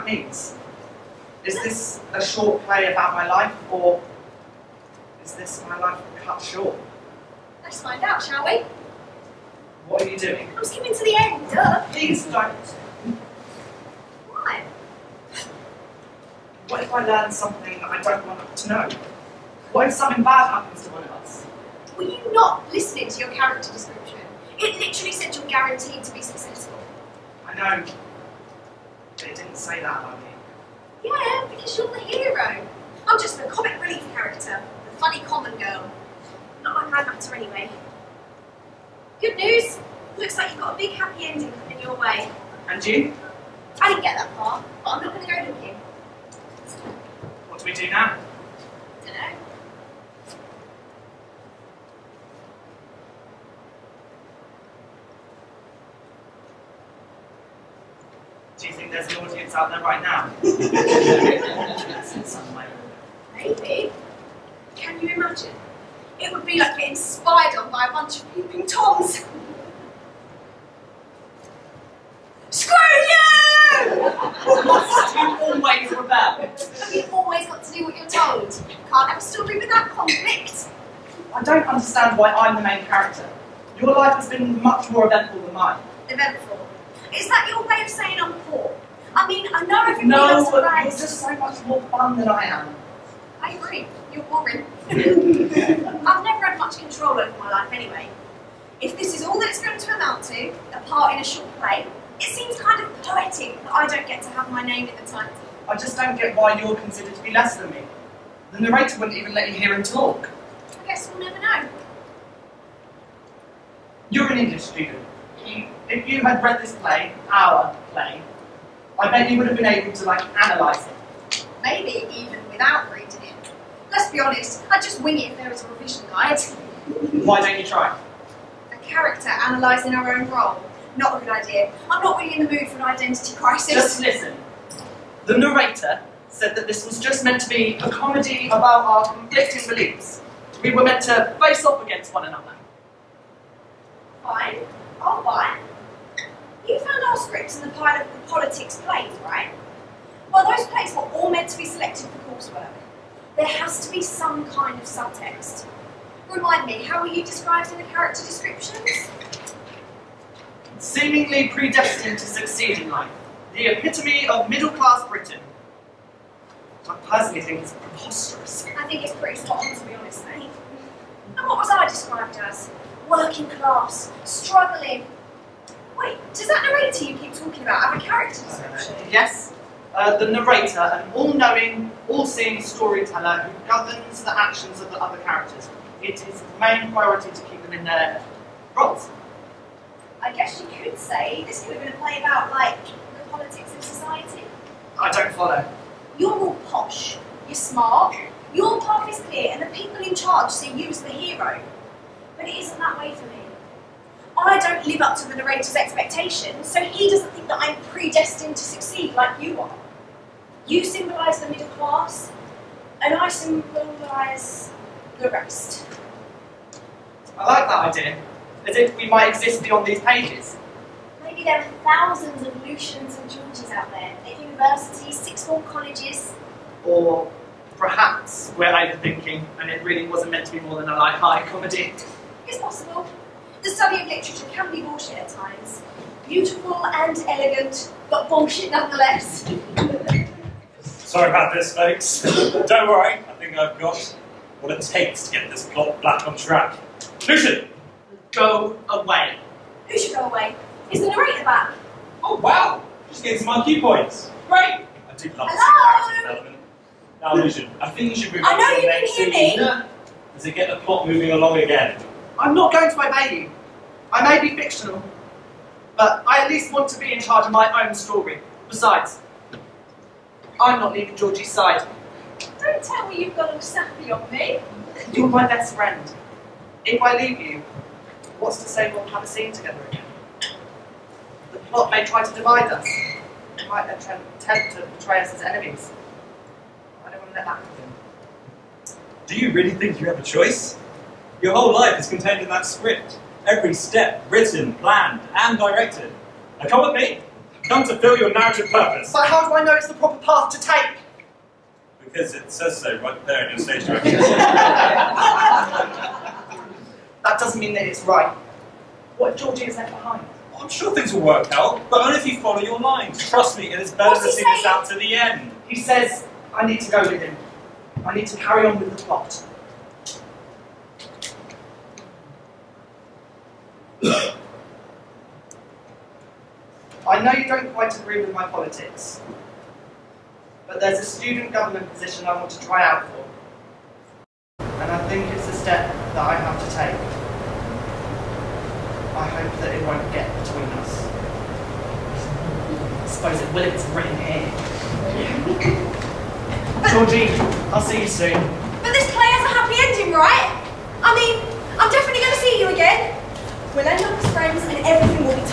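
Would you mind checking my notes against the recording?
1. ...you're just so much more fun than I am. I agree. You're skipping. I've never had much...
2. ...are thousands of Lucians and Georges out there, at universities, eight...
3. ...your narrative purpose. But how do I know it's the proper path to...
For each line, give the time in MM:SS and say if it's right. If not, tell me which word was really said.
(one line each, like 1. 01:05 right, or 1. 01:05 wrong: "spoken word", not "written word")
1. 01:30 wrong: "boring", not "skipping"
2. 03:41 wrong: "six", not "eight"
3. 04:58 right.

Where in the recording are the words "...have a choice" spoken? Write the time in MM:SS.
04:50.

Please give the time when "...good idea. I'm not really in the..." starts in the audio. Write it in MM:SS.
02:11.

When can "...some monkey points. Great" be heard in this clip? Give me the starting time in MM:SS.
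04:13.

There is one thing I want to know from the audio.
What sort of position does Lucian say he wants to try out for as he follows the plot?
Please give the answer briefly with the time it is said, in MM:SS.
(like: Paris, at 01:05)
student government position, at 05:31.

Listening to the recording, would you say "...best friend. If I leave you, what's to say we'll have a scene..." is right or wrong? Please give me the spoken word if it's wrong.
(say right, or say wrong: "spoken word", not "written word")
right.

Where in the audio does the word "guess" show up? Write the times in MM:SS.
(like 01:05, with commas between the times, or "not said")
01:50, 03:10.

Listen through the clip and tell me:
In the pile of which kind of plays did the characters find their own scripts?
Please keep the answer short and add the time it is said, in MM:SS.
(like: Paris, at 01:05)
politics plays, at 02:28.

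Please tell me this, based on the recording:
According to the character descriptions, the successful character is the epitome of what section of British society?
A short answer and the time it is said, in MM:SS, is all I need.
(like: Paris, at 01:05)
middle class Britain, at 02:44.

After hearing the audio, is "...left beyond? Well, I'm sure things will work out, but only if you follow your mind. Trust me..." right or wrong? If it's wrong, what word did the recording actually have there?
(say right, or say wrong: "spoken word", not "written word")
wrong: "behind", not "beyond".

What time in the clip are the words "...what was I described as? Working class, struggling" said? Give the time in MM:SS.
02:51.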